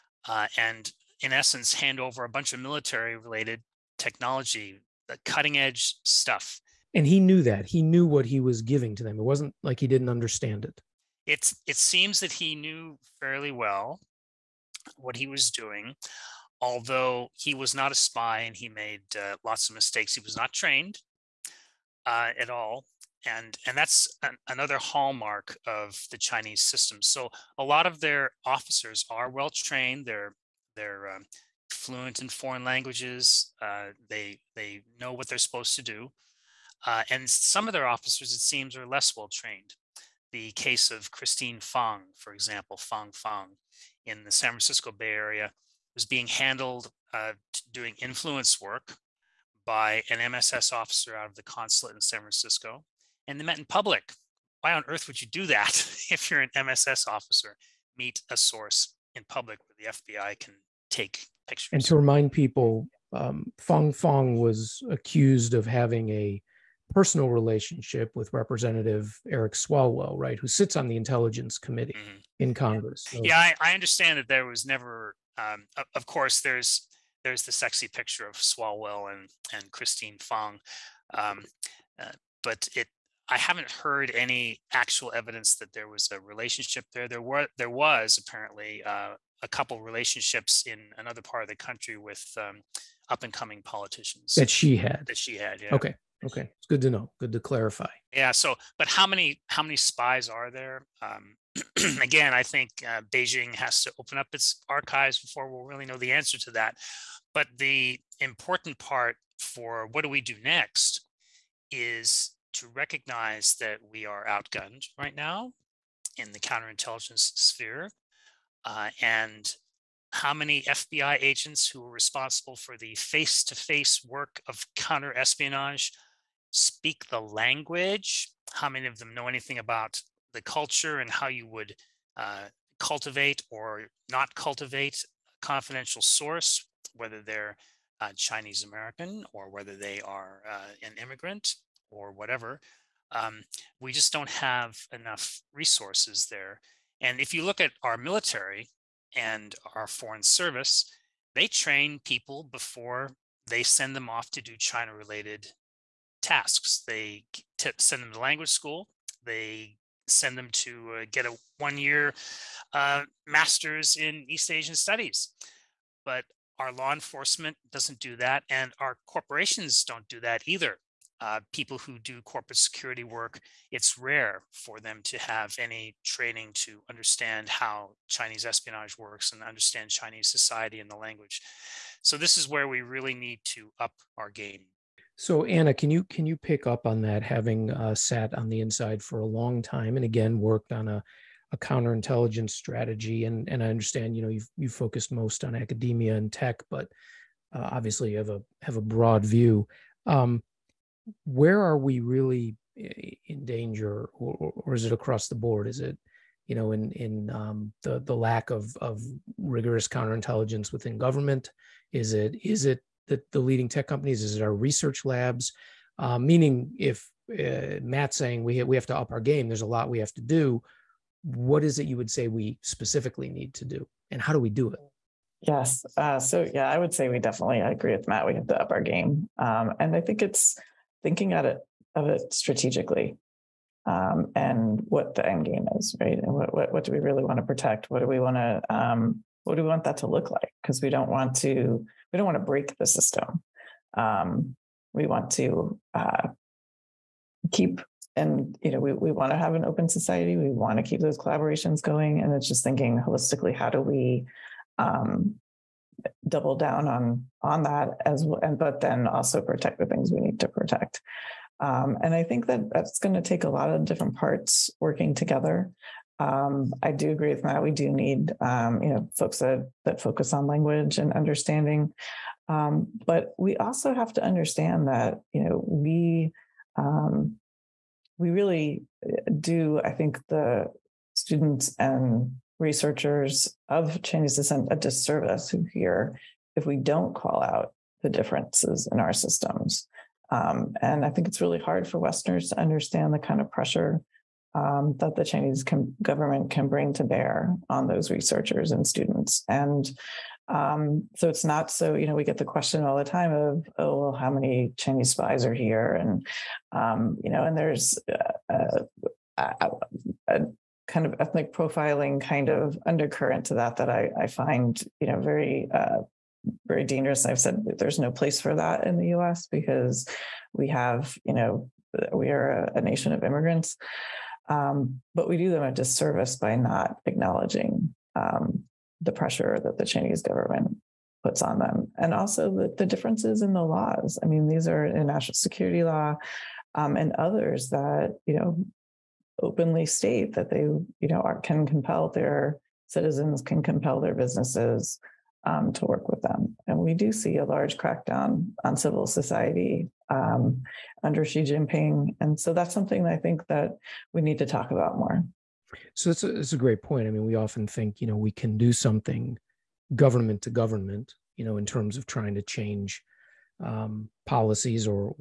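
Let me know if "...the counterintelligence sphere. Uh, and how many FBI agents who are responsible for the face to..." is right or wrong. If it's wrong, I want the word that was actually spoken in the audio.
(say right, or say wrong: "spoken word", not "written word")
right.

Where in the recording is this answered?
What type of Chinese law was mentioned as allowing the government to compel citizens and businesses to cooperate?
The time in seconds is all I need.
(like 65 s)
335 s.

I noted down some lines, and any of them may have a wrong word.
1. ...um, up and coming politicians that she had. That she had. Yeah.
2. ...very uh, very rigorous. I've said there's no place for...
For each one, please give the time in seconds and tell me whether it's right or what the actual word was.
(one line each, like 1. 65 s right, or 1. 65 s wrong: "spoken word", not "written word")
1. 92 s right
2. 315 s wrong: "dangerous", not "rigorous".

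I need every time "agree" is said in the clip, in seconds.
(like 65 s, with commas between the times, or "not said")
227 s, 267 s.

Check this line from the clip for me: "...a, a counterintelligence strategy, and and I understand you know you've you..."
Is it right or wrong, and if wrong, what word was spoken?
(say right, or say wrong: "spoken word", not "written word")
right.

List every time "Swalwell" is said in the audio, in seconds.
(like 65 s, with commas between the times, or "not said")
69 s, 78 s.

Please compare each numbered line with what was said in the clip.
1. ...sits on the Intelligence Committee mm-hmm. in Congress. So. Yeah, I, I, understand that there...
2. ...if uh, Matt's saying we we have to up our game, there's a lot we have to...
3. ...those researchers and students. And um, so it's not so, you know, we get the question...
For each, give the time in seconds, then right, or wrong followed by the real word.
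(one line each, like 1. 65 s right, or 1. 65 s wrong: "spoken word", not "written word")
1. 70 s right
2. 216 s right
3. 297 s right.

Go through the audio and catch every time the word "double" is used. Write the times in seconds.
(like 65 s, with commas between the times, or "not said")
256 s.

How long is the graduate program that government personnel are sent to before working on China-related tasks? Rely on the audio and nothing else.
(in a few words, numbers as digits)
one year.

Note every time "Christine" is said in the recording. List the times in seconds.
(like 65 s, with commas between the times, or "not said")
41 s, 79 s.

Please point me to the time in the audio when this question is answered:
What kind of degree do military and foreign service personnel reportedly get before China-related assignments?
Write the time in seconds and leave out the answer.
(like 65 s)
163 s.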